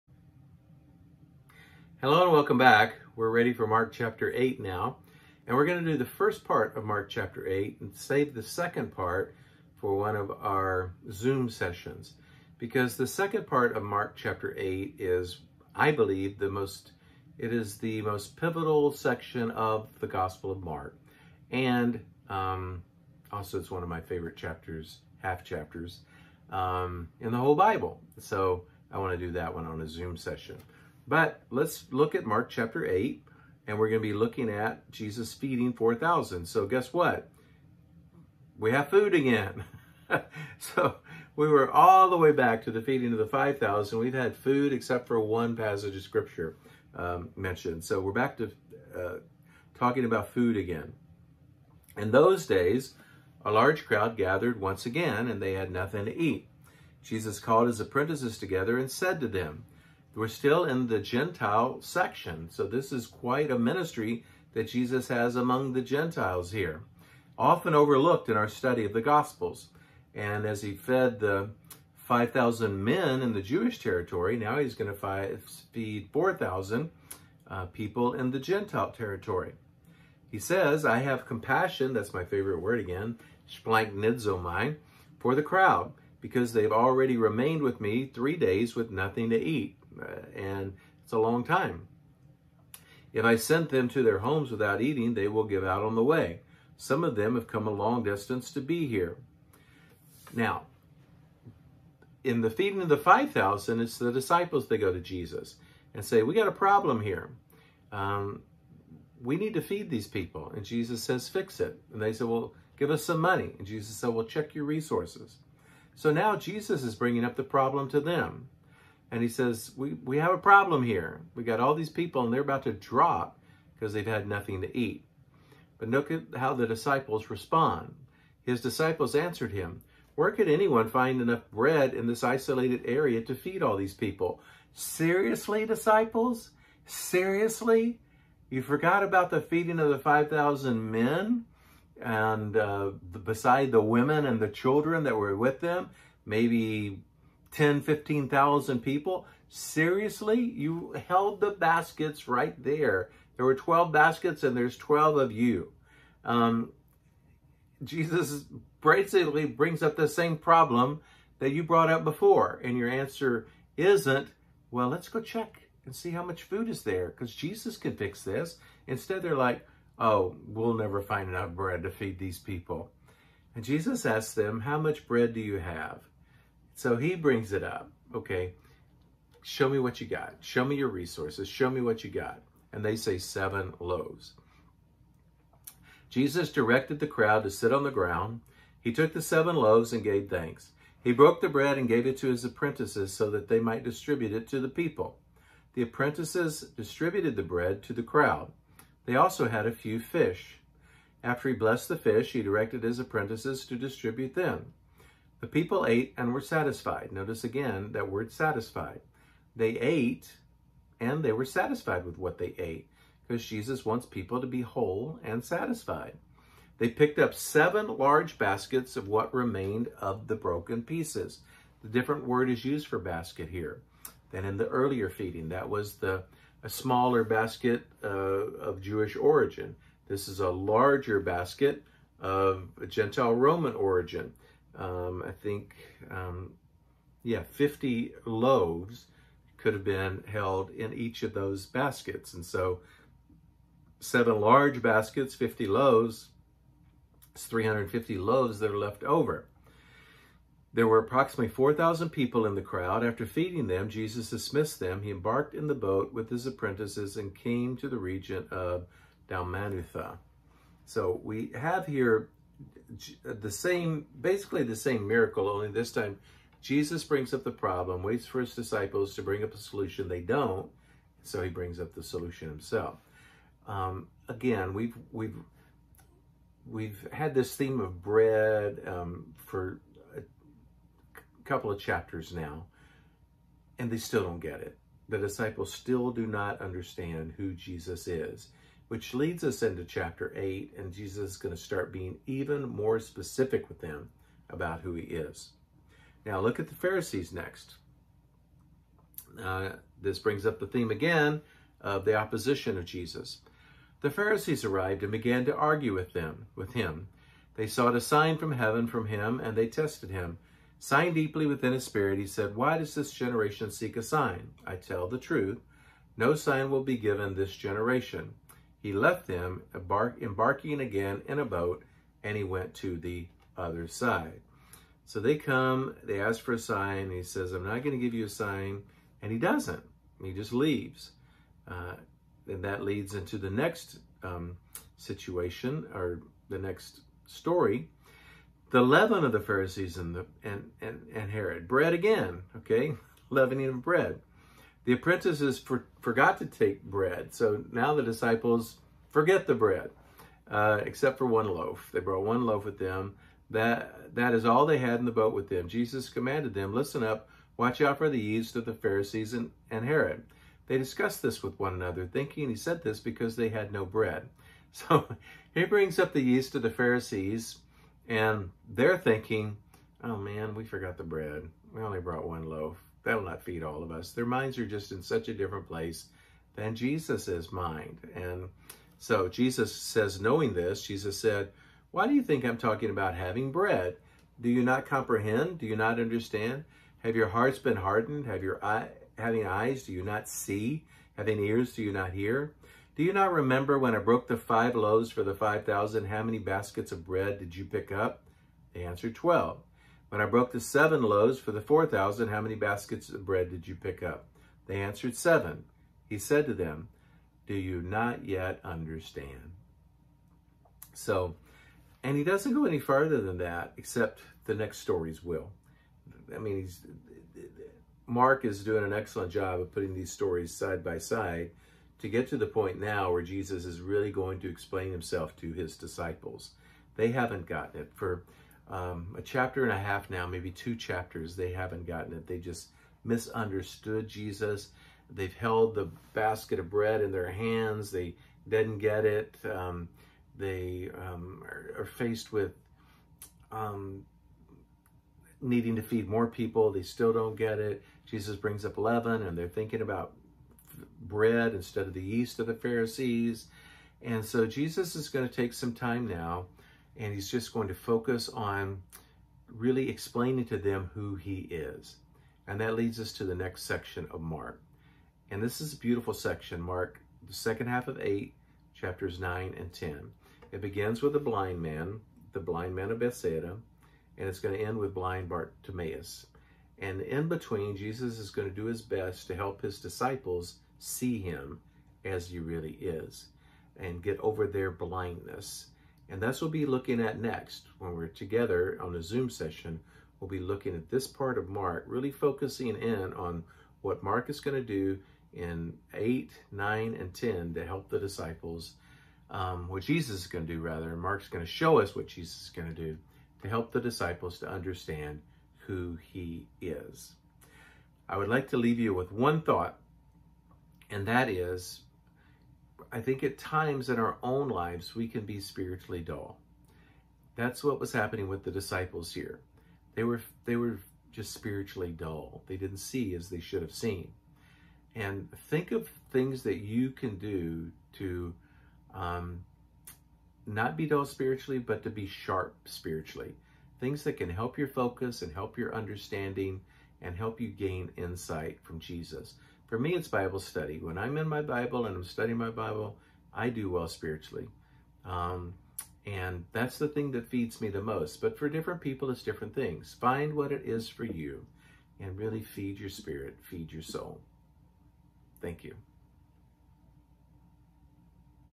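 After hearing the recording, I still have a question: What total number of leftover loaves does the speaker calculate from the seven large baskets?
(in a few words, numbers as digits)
350.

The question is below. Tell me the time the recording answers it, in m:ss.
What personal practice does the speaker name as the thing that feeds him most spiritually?
9:00.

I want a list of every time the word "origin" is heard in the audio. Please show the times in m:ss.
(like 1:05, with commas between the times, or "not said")
3:49, 3:53.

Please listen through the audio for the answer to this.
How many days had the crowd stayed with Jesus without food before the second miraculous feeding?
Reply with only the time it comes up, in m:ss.
1:28.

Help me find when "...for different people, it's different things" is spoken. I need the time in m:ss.
9:08.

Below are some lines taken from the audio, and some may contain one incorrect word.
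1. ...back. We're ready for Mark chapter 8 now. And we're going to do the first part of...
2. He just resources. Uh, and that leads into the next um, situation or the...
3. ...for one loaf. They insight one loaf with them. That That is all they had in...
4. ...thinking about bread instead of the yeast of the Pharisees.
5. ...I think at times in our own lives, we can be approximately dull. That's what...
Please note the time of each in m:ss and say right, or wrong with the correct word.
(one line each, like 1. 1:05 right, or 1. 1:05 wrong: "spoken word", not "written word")
1. 0:02 right
2. 5:30 wrong: "leaves", not "resources"
3. 5:51 wrong: "brought", not "insight"
4. 7:29 right
5. 8:32 wrong: "spiritually", not "approximately".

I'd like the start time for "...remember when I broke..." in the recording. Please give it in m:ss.
6:33.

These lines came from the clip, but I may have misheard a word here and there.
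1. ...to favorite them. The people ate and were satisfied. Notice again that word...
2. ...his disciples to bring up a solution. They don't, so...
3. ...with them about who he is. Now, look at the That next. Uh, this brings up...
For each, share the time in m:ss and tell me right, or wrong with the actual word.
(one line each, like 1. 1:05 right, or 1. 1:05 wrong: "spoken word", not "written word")
1. 3:23 wrong: "distribute", not "favorite"
2. 4:28 right
3. 4:53 wrong: "Pharisees", not "That".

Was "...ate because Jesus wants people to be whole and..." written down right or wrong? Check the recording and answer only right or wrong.
right.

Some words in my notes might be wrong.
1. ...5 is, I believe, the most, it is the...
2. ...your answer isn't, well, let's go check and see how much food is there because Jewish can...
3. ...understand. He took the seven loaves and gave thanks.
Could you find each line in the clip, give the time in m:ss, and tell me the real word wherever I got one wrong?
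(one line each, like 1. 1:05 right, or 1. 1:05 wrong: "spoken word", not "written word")
1. 0:14 wrong: "8", not "5"
2. 2:42 wrong: "Jesus", not "Jewish"
3. 3:07 wrong: "ground", not "understand".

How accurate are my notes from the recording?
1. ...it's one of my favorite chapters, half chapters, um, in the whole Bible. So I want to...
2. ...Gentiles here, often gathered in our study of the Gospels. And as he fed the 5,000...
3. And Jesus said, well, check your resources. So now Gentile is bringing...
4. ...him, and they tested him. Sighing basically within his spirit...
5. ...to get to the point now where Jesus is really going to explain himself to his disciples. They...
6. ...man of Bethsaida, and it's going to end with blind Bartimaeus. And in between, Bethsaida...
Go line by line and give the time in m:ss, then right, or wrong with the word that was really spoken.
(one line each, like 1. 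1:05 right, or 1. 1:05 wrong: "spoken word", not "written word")
1. 0:23 right
2. 1:05 wrong: "overlooked", not "gathered"
3. 1:53 wrong: "Jesus", not "Gentile"
4. 5:09 wrong: "deeply", not "basically"
5. 7:01 right
6. 7:52 wrong: "Jesus", not "Bethsaida".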